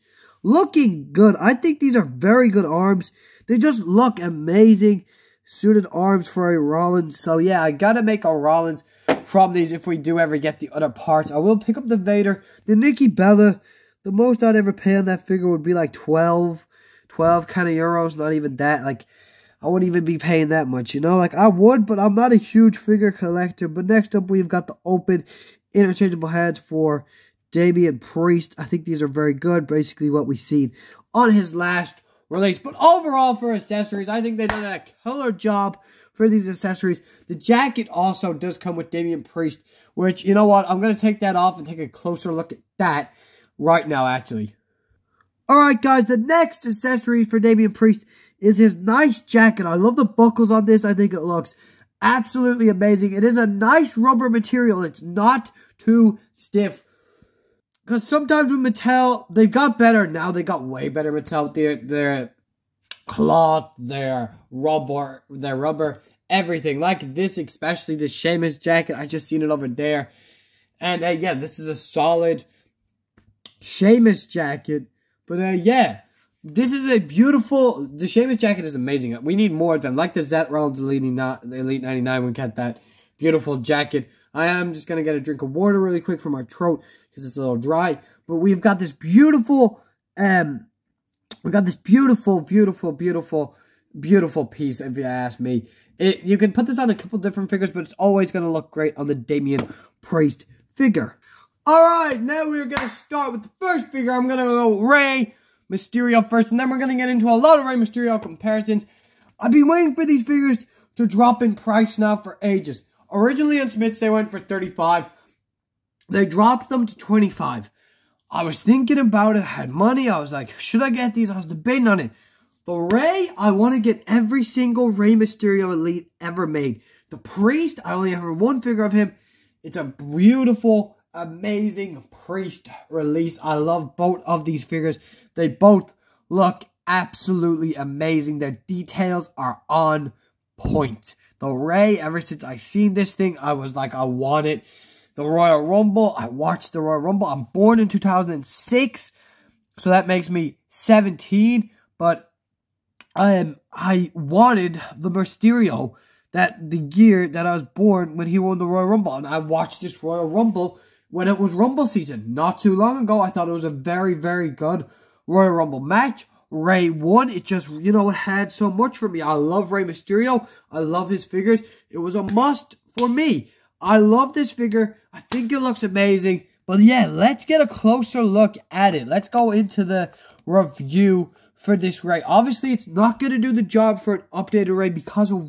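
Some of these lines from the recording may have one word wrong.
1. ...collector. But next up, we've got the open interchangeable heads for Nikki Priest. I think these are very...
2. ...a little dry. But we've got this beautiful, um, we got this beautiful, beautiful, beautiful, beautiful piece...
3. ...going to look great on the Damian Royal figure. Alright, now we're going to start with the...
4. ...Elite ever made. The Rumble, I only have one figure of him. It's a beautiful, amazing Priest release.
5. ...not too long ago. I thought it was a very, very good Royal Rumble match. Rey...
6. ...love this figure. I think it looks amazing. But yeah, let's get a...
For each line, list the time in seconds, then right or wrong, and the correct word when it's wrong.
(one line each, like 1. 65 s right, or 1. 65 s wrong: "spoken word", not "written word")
1. 23 s wrong: "Damian", not "Nikki"
2. 87 s right
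3. 98 s wrong: "Priest", not "Royal"
4. 125 s wrong: "Priest", not "Rumble"
5. 162 s right
6. 173 s right.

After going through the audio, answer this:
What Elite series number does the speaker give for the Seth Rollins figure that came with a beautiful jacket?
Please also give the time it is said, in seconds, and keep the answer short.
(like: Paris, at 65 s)
99, at 81 s.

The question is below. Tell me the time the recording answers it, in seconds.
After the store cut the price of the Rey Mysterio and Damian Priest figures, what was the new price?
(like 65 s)
116 s.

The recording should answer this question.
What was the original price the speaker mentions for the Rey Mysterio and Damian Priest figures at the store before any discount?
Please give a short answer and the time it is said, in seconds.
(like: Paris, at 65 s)
35, at 114 s.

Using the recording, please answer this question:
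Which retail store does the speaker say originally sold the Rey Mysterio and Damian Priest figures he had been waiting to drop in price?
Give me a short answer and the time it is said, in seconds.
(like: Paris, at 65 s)
Smyths, at 113 s.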